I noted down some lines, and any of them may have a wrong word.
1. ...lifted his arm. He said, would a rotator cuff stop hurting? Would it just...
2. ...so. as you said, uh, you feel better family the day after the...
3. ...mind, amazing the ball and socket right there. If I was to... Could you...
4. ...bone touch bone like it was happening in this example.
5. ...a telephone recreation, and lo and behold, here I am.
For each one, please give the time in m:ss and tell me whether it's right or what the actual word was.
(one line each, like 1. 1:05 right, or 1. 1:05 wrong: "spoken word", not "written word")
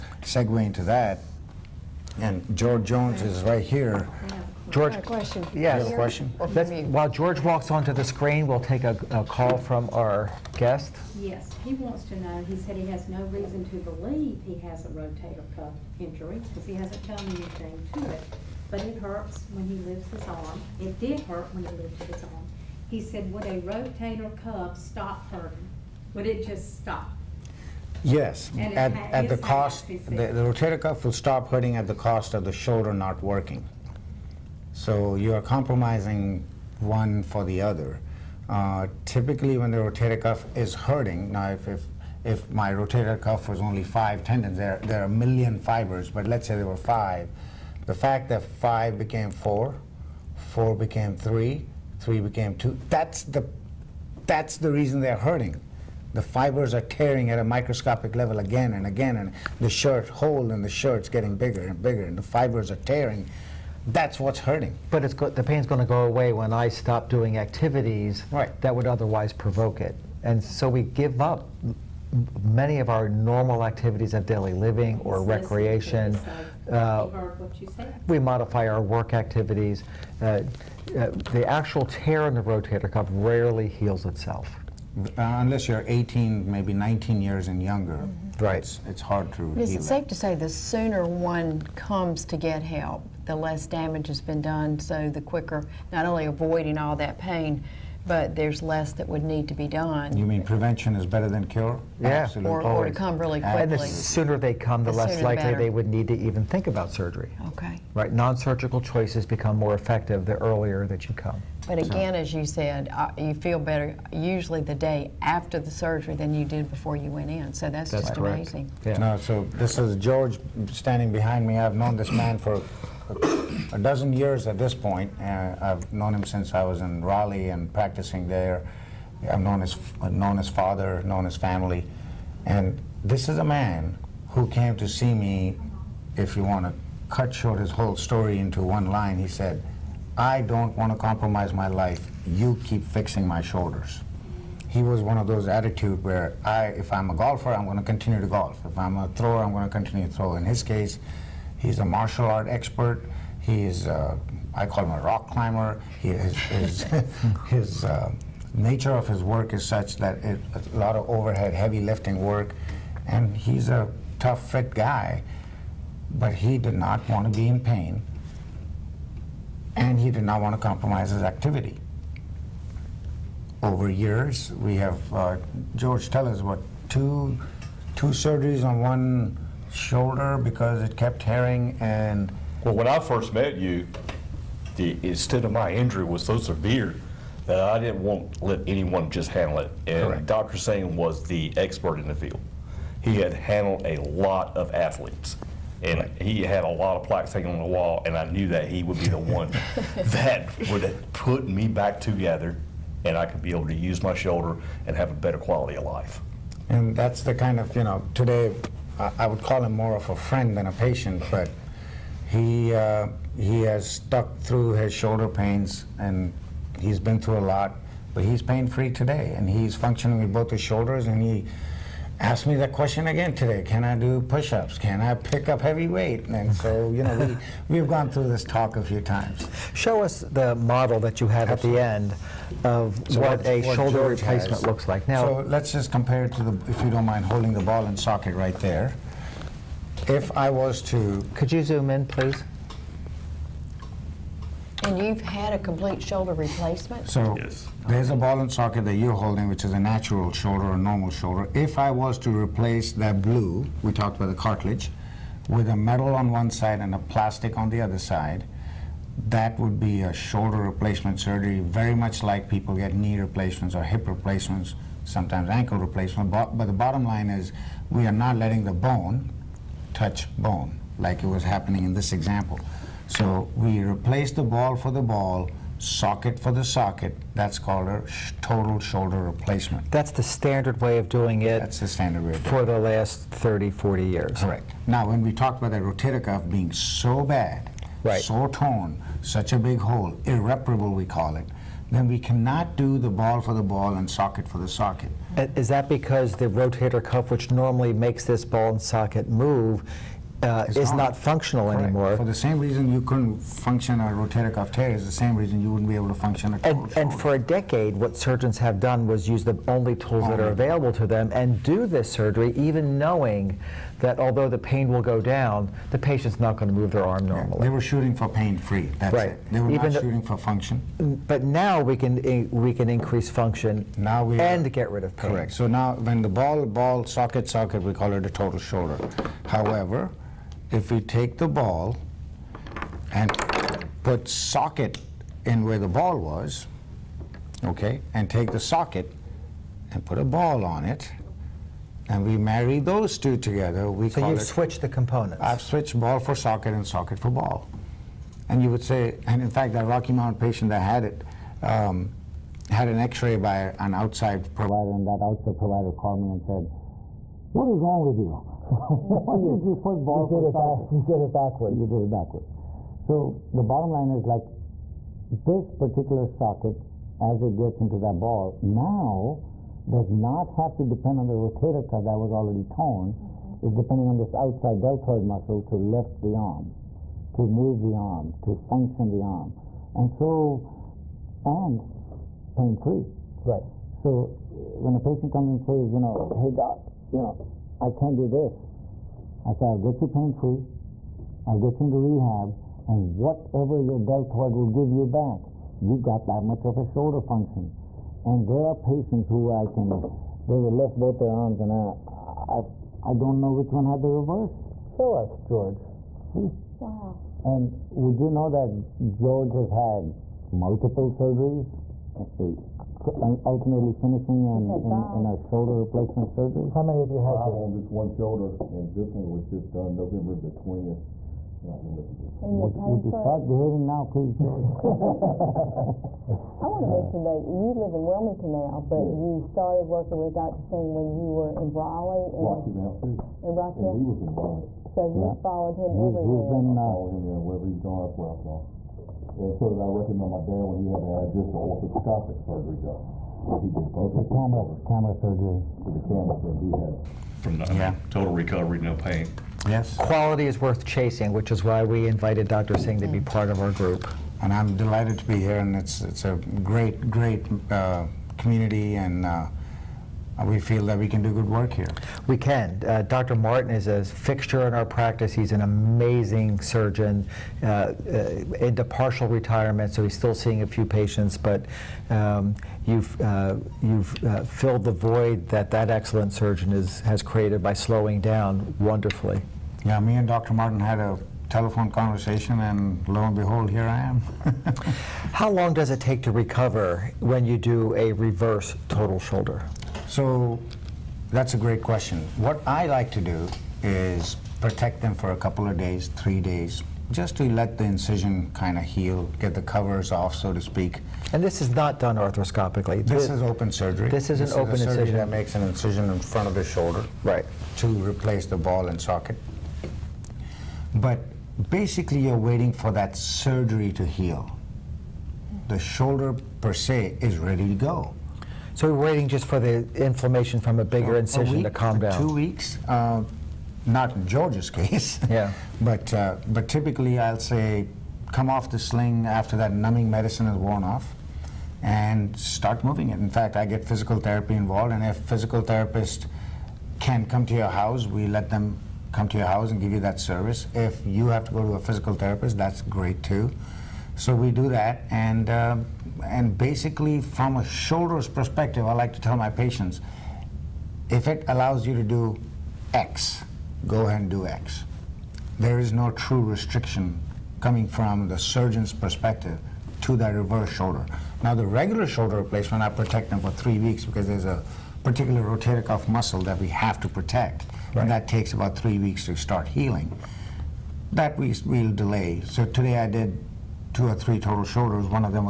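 1. 0:21 right
2. 1:52 wrong: "usually", not "family"
3. 3:57 wrong: "holding", not "amazing"
4. 4:28 right
5. 8:00 wrong: "conversation", not "recreation".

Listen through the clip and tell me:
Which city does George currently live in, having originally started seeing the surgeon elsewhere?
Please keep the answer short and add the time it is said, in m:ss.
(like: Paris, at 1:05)
Wilmington, at 7:08.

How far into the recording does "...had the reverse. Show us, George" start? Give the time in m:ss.
6:43.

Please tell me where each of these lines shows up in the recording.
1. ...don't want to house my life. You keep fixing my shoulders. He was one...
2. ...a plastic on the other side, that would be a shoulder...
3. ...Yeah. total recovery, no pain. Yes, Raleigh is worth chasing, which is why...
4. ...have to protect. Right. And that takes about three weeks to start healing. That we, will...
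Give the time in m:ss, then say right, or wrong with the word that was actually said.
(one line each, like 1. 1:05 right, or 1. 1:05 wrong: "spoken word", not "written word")
1. 2:20 wrong: "compromise", not "house"
2. 4:16 right
3. 7:27 wrong: "Quality", not "Raleigh"
4. 9:26 right.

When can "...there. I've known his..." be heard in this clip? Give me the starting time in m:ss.
2:08.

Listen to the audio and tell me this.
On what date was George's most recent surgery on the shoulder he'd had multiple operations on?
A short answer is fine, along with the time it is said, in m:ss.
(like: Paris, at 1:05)
November 20, at 6:59.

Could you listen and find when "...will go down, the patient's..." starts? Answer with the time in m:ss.
5:14.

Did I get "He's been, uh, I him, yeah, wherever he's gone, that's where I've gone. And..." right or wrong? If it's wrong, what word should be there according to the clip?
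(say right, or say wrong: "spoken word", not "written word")
right.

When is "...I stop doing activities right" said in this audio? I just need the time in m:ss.
1:06.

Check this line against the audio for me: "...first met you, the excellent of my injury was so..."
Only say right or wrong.
wrong.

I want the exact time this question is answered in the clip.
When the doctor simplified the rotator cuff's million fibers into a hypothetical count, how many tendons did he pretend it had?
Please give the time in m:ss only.
0:43.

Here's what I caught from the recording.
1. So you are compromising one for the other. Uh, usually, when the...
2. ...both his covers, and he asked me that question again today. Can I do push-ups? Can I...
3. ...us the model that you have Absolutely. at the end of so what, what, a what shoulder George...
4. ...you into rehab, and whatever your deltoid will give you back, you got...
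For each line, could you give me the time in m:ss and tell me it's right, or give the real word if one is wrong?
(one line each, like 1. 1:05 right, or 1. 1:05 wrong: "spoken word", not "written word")
1. 0:34 wrong: "typically", not "usually"
2. 3:40 wrong: "shoulders", not "covers"
3. 3:50 right
4. 6:31 right.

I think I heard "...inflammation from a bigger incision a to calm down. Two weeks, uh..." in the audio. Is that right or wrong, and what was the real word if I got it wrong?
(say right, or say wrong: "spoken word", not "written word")
right.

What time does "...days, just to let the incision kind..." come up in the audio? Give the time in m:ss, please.
8:16.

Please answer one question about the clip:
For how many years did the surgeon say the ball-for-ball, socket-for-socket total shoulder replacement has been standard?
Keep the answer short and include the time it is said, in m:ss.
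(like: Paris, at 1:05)
30 to 40 years, at 4:43.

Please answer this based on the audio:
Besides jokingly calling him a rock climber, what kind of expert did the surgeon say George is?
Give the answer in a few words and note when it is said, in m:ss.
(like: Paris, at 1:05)
Martial art expert, at 2:31.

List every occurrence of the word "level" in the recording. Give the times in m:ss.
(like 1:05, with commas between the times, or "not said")
0:58.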